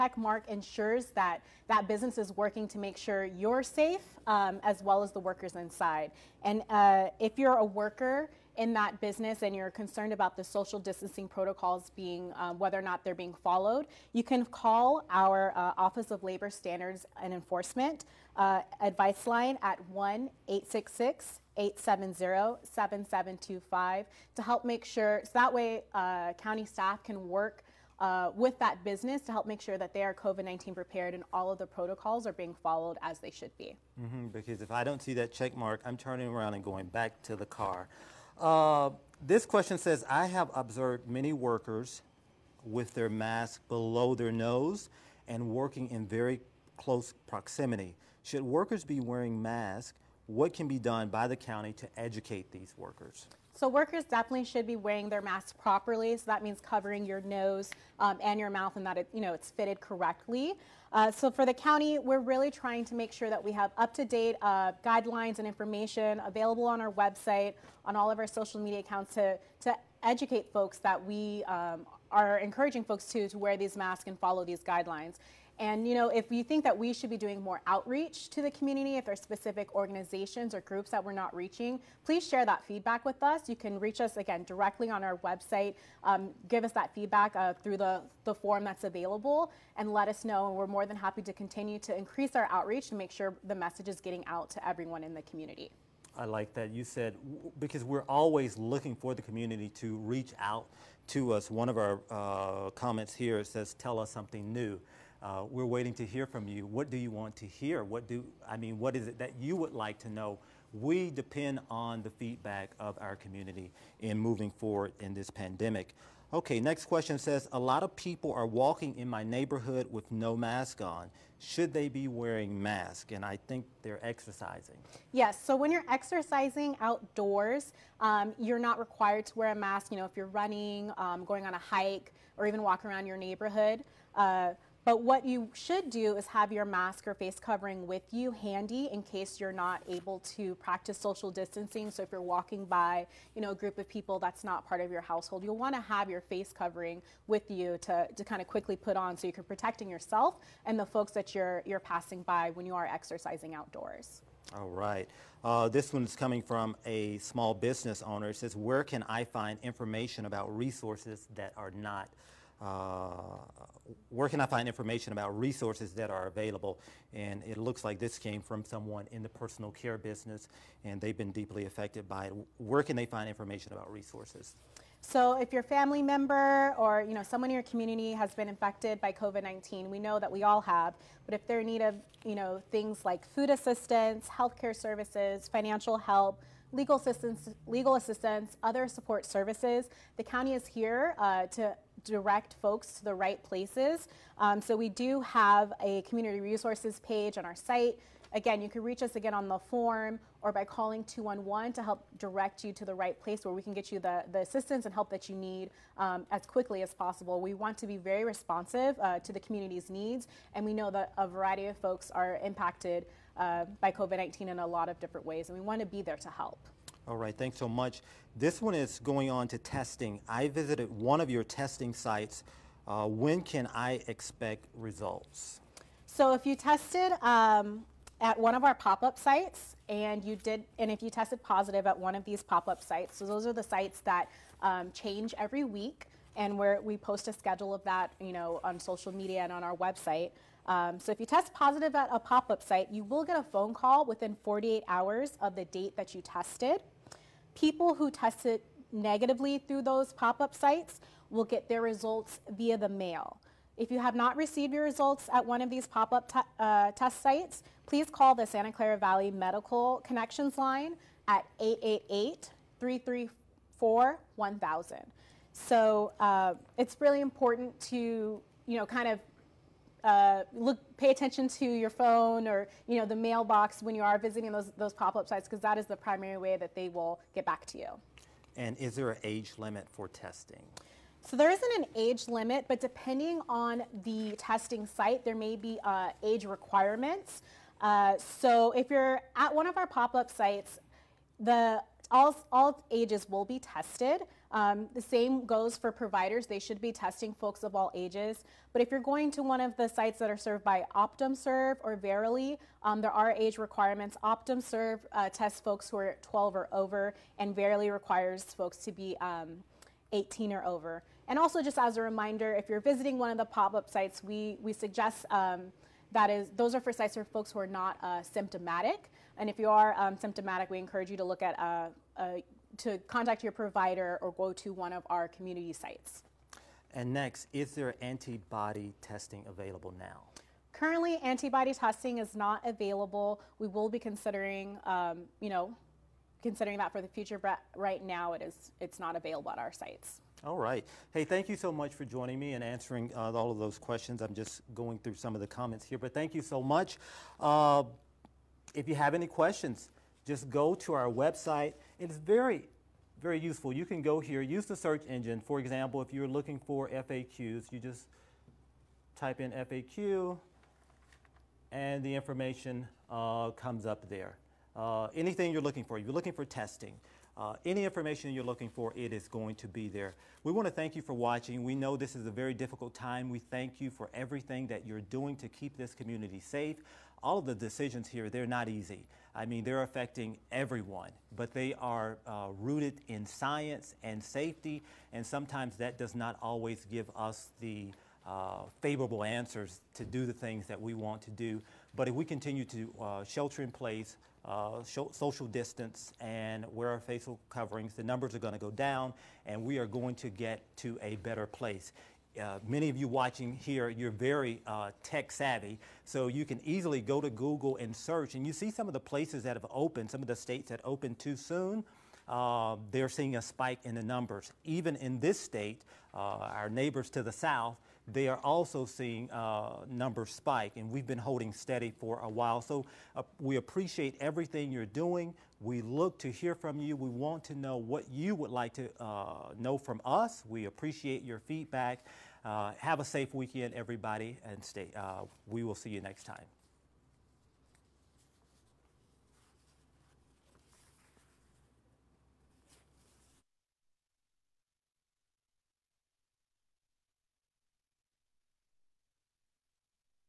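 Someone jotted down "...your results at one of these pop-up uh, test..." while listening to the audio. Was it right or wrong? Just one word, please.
right.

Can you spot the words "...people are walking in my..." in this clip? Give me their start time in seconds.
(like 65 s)
117 s.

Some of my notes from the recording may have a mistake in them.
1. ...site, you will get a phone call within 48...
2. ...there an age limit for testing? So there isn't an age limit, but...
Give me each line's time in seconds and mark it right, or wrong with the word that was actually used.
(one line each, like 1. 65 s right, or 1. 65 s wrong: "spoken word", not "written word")
1. 242 s right
2. 278 s right.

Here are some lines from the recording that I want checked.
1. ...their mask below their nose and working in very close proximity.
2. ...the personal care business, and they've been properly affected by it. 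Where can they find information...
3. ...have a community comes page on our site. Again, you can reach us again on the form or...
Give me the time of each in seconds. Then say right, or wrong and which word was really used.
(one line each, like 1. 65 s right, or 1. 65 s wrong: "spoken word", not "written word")
1. 42 s right
2. 169 s wrong: "deeply", not "properly"
3. 195 s wrong: "resources", not "comes".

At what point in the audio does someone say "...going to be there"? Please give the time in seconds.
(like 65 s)
369 s.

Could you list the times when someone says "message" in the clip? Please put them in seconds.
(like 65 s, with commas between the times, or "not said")
93 s.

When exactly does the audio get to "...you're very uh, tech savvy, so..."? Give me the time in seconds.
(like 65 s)
403 s.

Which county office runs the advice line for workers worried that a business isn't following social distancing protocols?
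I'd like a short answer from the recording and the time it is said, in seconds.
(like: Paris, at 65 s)
Office of Labor Standards and Enforcement, at 15 s.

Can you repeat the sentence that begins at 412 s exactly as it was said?
Uh, they're seeing a spike in the numbers.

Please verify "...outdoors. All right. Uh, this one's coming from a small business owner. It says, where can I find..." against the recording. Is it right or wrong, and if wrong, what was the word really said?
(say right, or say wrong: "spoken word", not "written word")
right.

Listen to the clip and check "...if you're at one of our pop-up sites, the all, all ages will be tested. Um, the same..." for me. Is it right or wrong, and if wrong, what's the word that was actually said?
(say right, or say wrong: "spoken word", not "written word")
right.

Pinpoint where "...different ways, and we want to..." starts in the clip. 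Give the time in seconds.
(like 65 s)
214 s.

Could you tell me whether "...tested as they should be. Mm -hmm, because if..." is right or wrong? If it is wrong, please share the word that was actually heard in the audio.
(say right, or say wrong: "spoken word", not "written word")
wrong: "followed", not "tested".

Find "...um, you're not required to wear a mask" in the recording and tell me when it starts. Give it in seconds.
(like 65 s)
127 s.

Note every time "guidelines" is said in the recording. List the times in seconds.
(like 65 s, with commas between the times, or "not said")
64 s, 74 s.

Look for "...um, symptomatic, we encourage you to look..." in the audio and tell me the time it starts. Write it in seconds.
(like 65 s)
319 s.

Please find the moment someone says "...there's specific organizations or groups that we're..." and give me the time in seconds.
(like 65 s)
79 s.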